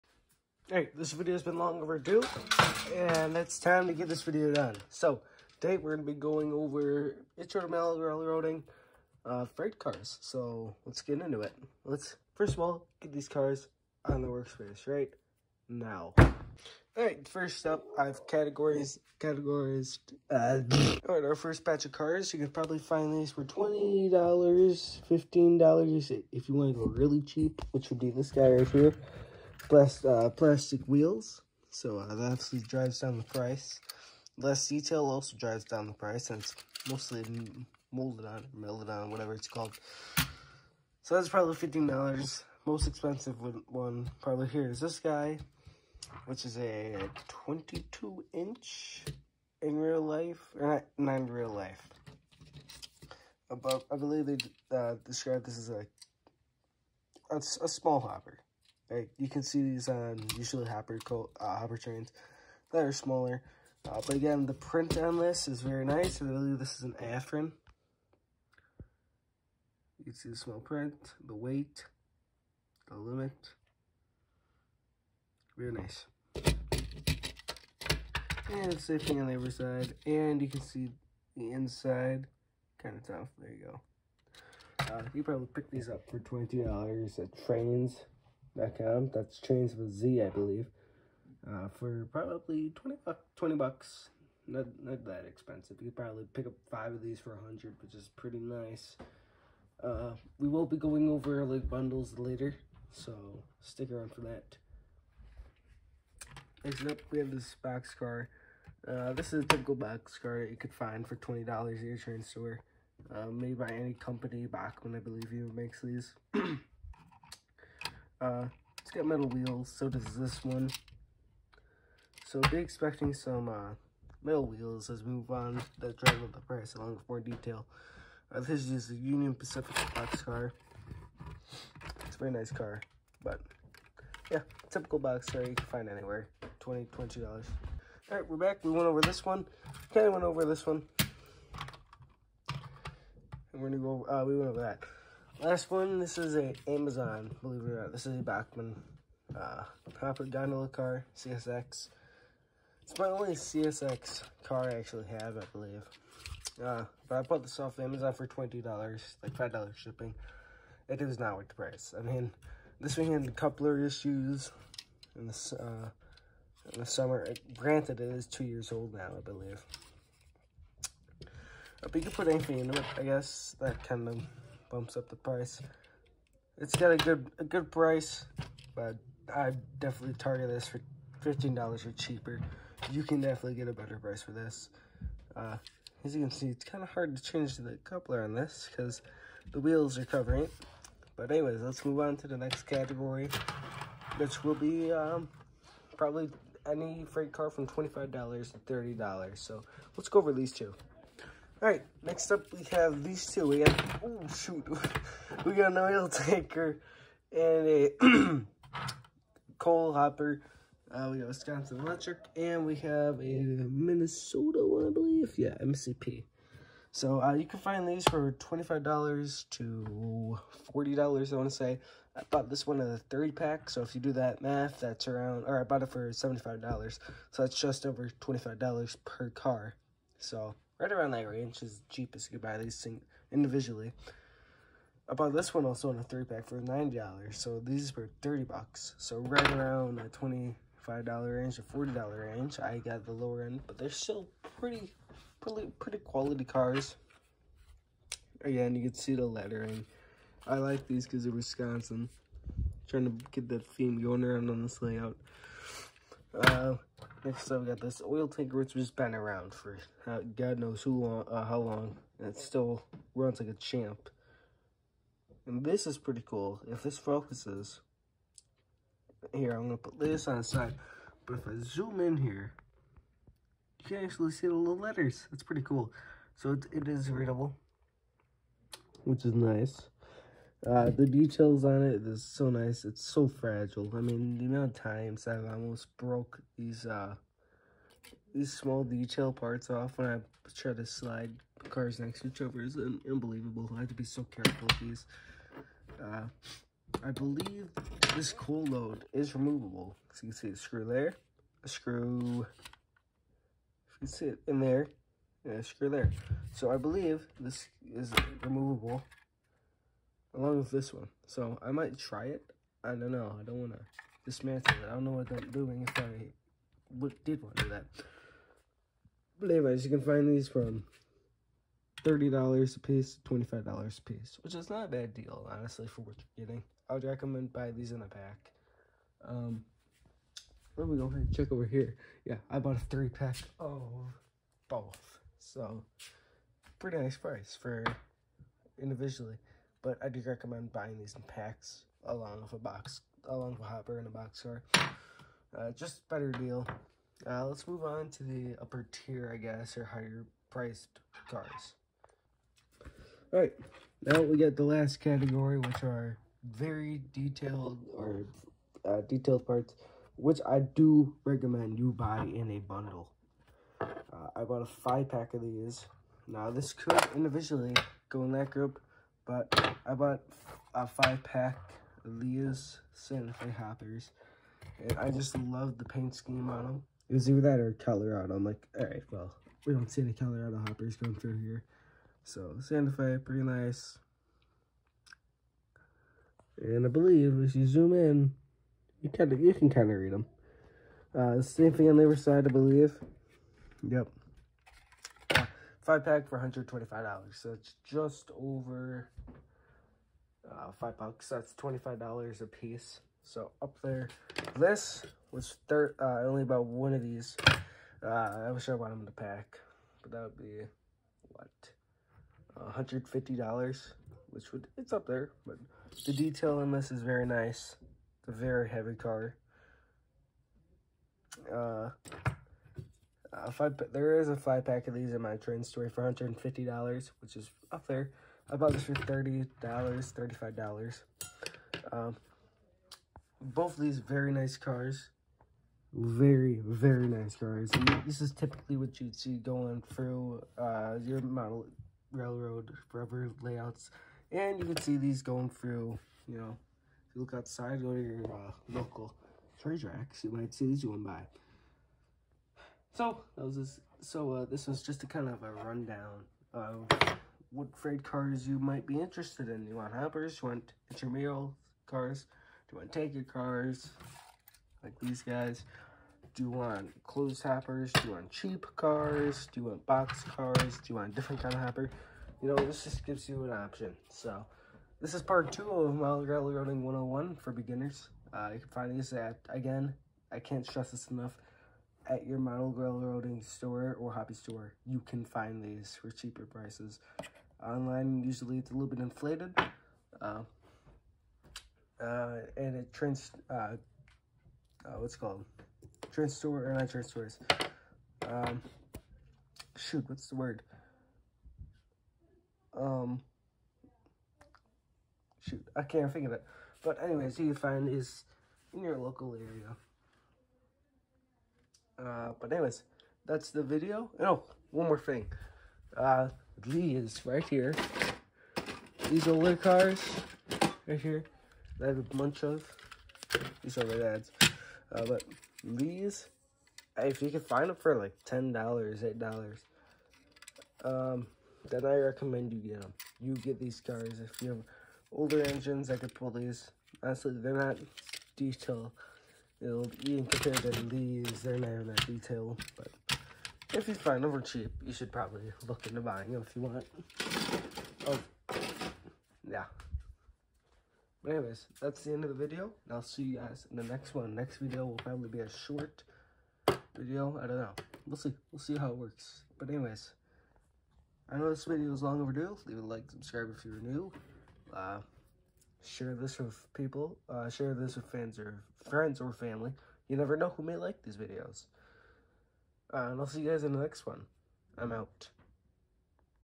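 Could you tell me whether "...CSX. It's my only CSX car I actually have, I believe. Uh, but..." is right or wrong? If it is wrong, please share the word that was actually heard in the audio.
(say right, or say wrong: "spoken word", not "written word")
right.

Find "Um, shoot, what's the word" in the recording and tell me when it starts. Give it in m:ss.
8:18.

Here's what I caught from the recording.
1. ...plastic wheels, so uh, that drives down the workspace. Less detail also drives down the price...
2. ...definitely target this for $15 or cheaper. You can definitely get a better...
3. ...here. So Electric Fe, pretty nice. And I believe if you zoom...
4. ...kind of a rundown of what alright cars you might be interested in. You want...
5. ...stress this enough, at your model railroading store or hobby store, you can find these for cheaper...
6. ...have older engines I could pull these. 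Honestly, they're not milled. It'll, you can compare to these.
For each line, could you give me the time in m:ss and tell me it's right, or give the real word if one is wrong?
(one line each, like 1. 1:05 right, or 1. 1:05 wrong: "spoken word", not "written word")
1. 0:30 wrong: "price", not "workspace"
2. 2:59 right
3. 6:21 wrong: "Santa", not "Electric"
4. 7:35 wrong: "freight", not "alright"
5. 8:00 right
6. 8:54 wrong: "detailed", not "milled".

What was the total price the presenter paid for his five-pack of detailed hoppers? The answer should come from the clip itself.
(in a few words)
$125.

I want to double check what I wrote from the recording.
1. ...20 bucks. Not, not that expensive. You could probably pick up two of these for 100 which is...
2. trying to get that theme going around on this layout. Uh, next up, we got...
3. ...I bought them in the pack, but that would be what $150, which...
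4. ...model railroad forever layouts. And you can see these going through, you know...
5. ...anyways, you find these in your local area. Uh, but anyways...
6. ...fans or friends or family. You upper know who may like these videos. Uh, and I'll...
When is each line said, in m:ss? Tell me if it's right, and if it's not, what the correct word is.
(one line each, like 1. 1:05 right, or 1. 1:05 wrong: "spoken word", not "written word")
1. 1:33 wrong: "five", not "two"
2. 4:12 right
3. 6:48 right
4. 7:21 right
5. 8:27 right
6. 9:28 wrong: "never", not "upper".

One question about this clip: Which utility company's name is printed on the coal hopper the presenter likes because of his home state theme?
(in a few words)
Wisconsin Electric.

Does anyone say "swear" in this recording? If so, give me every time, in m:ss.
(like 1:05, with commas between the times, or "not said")
not said.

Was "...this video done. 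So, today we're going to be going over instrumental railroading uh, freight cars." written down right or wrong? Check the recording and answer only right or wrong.
right.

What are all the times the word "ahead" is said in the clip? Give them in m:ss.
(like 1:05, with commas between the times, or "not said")
5:31.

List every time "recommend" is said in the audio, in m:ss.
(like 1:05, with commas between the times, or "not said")
5:27, 5:40, 6:01, 8:51.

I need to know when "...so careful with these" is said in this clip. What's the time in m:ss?
4:54.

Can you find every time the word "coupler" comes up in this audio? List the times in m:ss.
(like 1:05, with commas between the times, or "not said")
2:43, 3:07.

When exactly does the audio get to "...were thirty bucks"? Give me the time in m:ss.
3:57.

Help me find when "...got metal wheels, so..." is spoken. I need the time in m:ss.
1:58.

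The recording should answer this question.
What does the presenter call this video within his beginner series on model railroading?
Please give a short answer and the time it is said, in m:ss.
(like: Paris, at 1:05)
part two, at 7:55.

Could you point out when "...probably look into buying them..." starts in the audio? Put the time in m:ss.
9:05.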